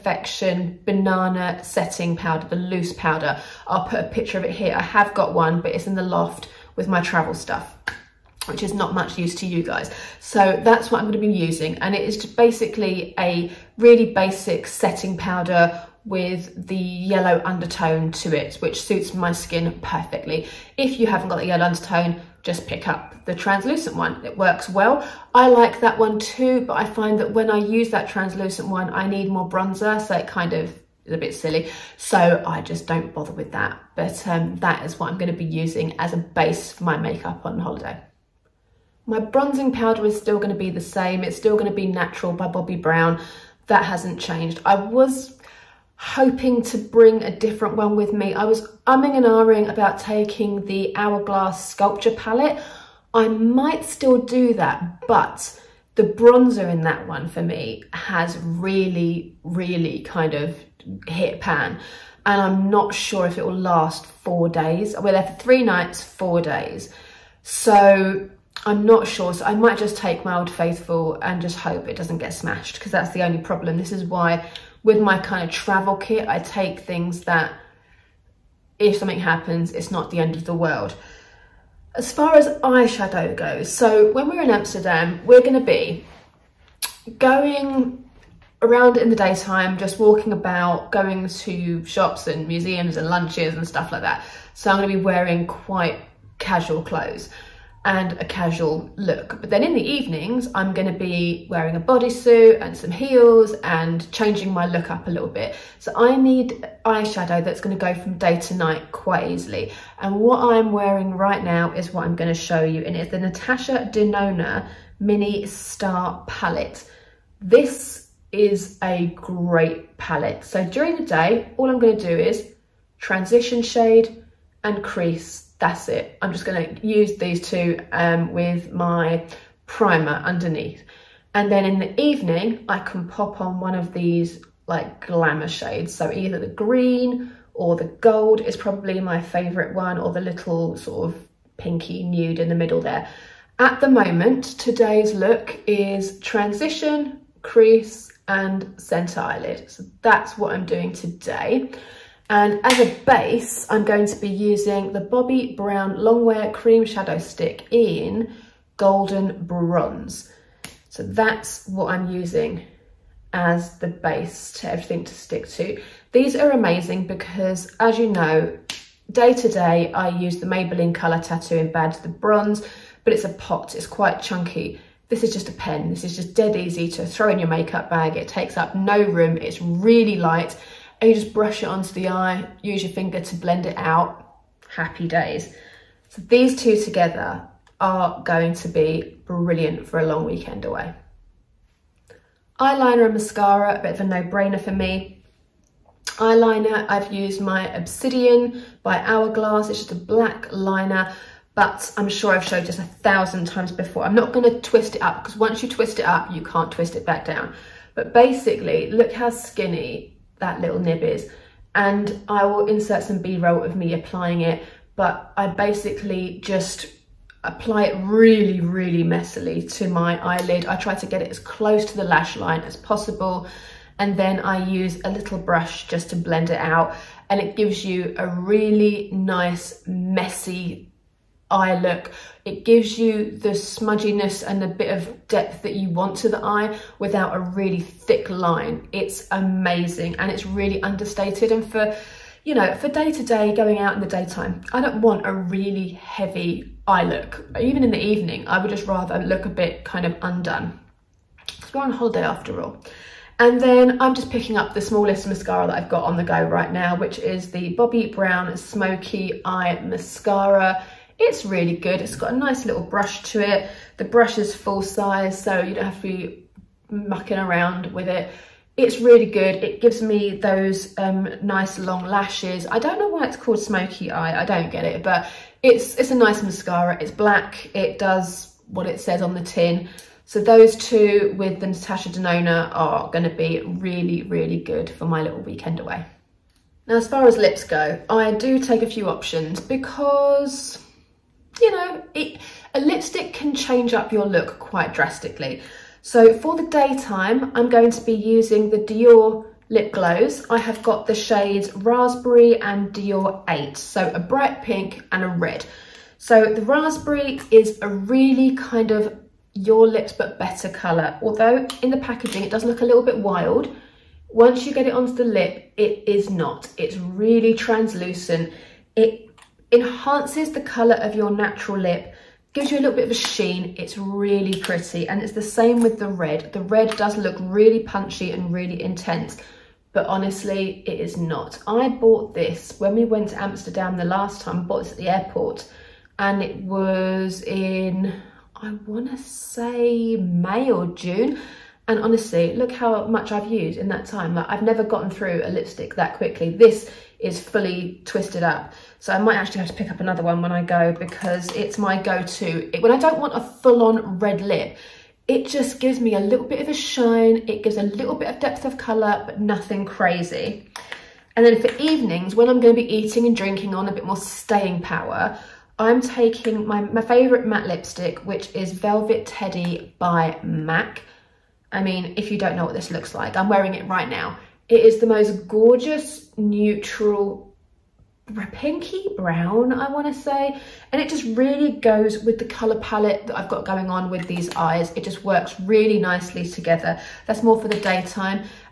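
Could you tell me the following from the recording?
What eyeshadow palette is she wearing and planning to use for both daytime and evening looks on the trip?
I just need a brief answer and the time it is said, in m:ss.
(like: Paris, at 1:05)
Natasha Denona Mini Star Palette, at 1:53.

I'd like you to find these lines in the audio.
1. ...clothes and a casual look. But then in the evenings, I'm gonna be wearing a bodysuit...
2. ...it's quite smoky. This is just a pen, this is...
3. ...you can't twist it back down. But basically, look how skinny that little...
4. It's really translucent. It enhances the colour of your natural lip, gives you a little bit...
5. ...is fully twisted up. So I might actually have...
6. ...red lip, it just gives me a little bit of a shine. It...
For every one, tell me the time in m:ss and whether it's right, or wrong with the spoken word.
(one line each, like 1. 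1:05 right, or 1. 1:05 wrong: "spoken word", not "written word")
1. 1:36 right
2. 2:53 wrong: "chunky", not "smoky"
3. 3:26 right
4. 5:16 right
5. 5:47 right
6. 5:54 right.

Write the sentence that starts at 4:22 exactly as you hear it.
It's got a nice little brush to it.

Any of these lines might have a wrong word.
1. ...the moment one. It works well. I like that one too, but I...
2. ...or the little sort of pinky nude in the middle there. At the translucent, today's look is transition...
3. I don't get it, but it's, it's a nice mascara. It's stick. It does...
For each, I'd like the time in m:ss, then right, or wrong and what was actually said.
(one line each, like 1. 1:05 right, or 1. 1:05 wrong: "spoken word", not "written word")
1. 0:23 wrong: "translucent", not "moment"
2. 2:19 wrong: "moment", not "translucent"
3. 4:34 wrong: "black", not "stick".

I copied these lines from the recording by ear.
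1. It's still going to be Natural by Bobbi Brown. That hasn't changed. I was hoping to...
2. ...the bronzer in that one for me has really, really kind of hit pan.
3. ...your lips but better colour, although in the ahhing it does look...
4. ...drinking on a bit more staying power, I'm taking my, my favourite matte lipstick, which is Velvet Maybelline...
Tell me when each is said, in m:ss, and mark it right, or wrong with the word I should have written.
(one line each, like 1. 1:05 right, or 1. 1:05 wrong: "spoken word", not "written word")
1. 0:41 right
2. 0:55 right
3. 5:09 wrong: "packaging", not "ahhing"
4. 6:03 wrong: "Teddy", not "Maybelline".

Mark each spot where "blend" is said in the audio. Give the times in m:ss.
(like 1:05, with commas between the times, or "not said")
3:03, 3:46.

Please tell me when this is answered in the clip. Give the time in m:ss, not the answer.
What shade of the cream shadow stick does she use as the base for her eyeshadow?
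2:38.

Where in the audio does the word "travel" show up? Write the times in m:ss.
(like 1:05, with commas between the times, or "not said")
0:07, 1:15.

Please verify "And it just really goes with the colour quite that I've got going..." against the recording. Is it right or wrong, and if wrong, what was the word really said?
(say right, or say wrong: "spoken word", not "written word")
wrong: "palette", not "quite".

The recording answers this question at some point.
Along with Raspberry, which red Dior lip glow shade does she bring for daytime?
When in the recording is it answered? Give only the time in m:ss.
5:02.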